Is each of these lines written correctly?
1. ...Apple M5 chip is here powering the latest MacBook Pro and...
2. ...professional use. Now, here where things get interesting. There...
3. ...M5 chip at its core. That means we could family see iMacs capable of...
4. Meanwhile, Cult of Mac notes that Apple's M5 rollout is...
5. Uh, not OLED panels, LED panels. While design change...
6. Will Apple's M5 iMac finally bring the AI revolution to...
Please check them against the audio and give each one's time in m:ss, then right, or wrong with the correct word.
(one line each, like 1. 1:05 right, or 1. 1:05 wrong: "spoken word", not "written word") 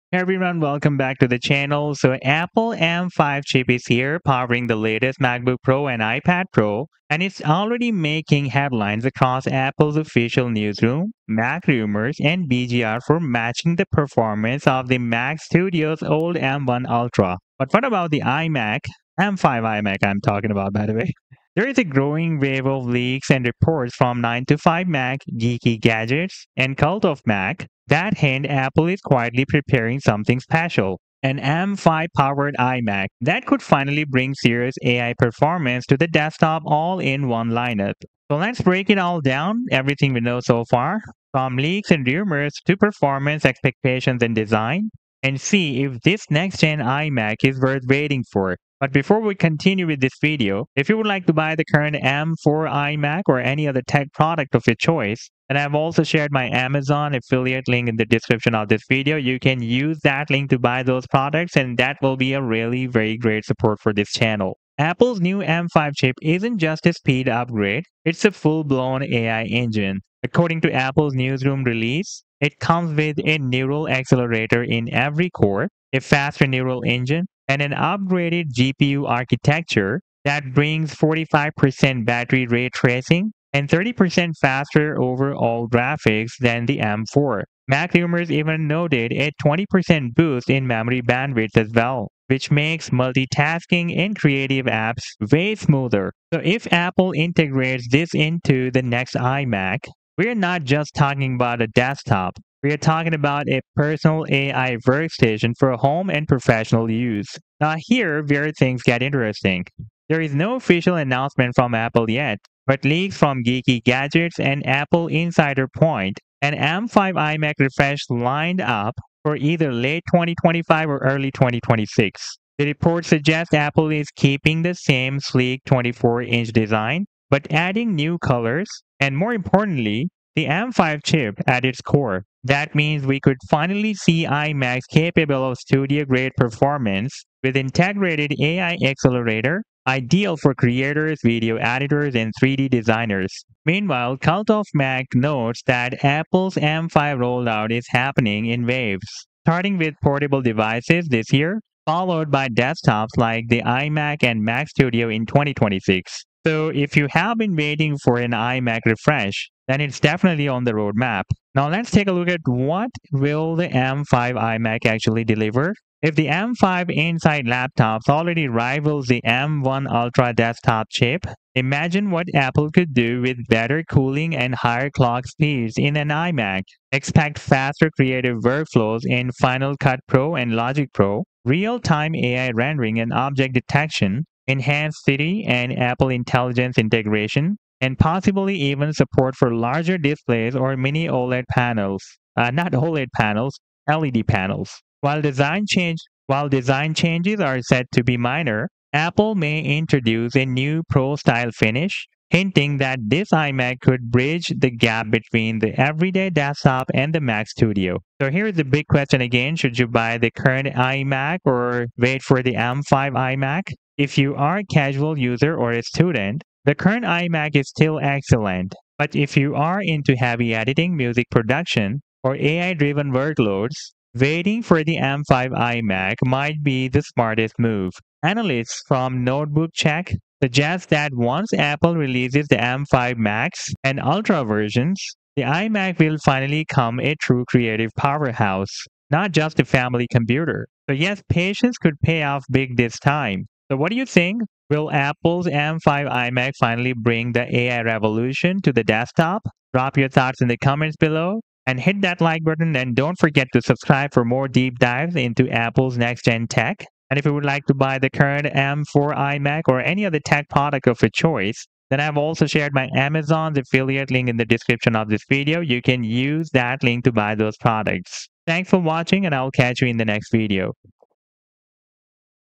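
1. 0:02 right
2. 1:46 right
3. 2:10 wrong: "finally", not "family"
4. 2:23 right
5. 3:12 right
6. 4:04 right.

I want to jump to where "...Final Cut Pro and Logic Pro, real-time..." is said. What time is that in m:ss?
2:59.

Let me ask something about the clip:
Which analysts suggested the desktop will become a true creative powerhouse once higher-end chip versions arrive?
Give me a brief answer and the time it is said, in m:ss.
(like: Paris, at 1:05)
Notebook Check, at 3:49.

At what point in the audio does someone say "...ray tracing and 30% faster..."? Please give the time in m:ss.
1:22.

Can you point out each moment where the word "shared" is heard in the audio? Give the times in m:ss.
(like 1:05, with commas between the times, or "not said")
0:56, 4:22.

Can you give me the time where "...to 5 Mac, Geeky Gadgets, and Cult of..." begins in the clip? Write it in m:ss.
0:24.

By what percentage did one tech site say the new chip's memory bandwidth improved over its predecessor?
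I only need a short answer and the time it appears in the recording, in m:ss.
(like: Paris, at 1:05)
20%, at 1:29.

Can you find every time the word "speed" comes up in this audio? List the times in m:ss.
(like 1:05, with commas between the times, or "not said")
1:06, 2:55.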